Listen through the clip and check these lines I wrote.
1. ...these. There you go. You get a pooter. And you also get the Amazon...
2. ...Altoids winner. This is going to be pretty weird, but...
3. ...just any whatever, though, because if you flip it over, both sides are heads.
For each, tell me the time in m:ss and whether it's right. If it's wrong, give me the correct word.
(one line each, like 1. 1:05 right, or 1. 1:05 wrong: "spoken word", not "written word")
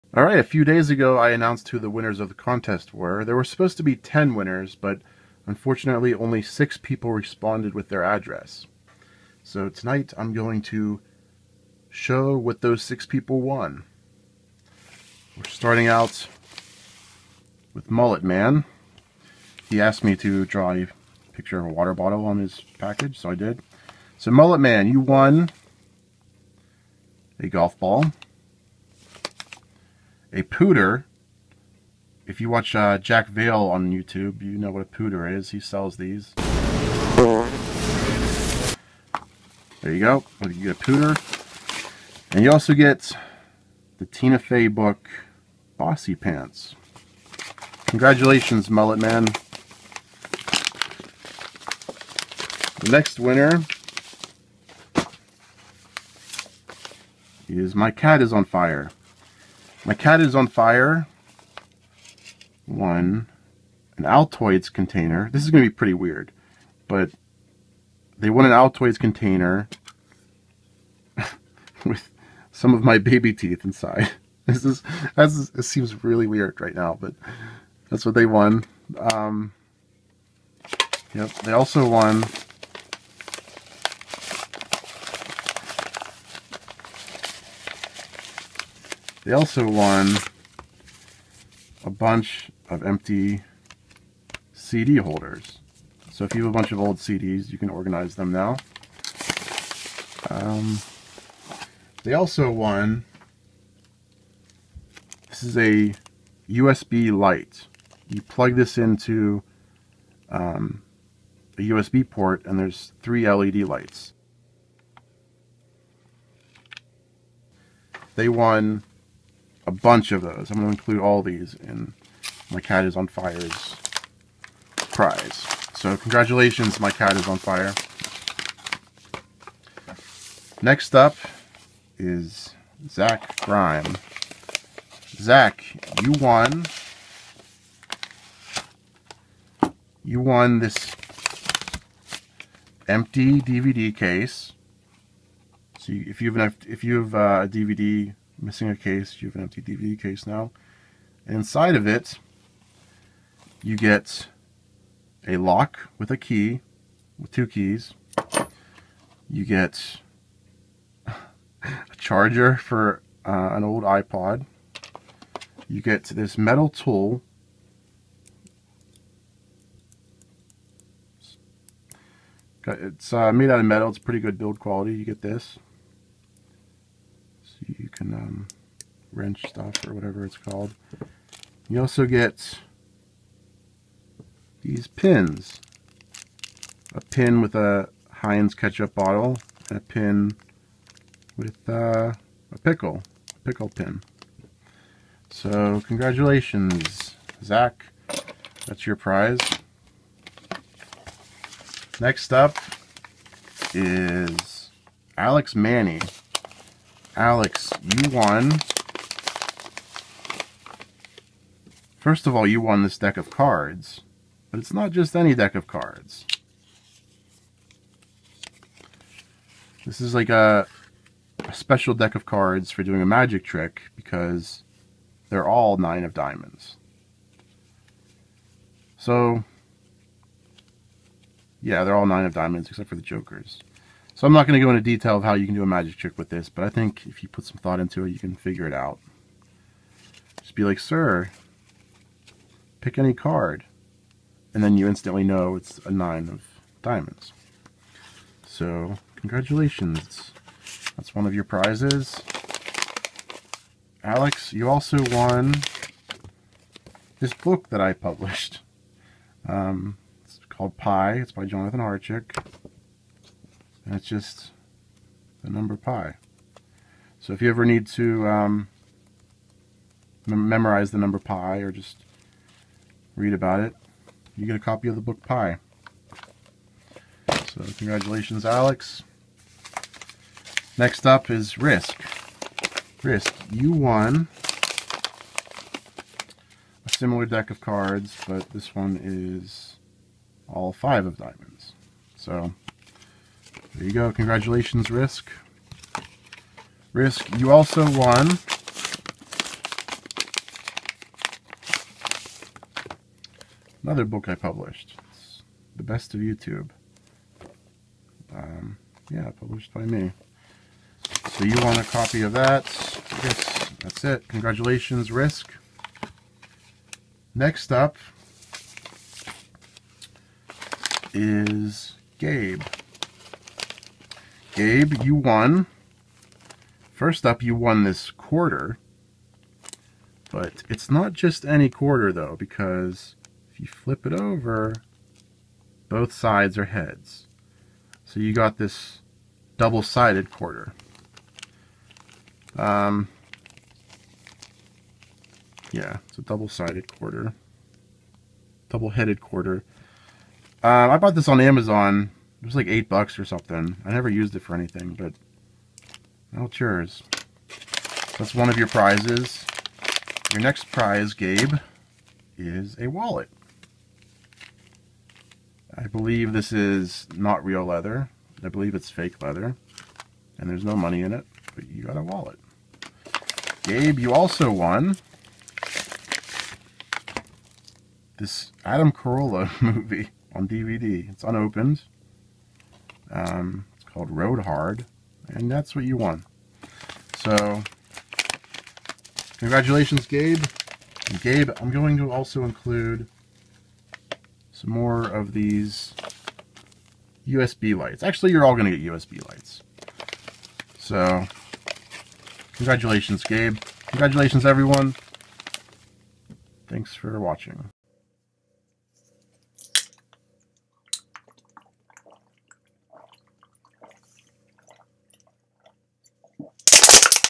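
1. 0:35 wrong: "Tina", not "Amazon"
2. 1:04 wrong: "container", not "winner"
3. 5:31 wrong: "quarter", not "whatever".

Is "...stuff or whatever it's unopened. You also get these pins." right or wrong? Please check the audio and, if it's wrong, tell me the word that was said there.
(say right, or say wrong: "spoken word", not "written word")
wrong: "called", not "unopened".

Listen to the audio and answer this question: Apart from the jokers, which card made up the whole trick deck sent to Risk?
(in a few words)
Five of diamonds.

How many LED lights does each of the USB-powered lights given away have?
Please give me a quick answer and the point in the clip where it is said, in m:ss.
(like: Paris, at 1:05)
3, at 1:53.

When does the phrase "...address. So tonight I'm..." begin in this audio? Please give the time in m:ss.
0:08.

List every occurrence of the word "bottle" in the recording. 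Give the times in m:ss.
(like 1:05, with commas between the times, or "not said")
0:21, 3:08.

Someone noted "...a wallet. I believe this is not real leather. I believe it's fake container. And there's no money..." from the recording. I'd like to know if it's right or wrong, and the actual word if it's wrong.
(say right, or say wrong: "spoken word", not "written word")
wrong: "leather", not "container".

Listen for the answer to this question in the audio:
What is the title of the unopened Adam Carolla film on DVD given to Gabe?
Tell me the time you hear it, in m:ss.
6:24.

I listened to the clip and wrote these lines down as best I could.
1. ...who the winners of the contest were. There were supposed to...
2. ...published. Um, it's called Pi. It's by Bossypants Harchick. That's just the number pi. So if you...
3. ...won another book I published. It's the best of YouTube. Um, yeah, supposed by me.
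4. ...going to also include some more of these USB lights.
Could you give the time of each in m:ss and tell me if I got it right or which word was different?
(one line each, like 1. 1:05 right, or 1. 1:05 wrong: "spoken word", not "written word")
1. 0:01 right
2. 4:17 wrong: "Jonathan", not "Bossypants"
3. 4:57 wrong: "published", not "supposed"
4. 6:31 right.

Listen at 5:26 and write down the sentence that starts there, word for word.
First up, you won this quarter.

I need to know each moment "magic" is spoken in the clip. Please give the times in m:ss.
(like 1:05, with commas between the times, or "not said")
3:43, 3:55.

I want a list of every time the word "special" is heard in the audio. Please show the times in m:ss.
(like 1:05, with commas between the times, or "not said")
3:41.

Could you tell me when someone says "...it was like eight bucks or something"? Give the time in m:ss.
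5:52.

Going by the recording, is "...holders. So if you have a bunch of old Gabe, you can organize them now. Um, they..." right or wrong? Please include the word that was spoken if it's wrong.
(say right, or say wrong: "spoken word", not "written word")
wrong: "CDs", not "Gabe".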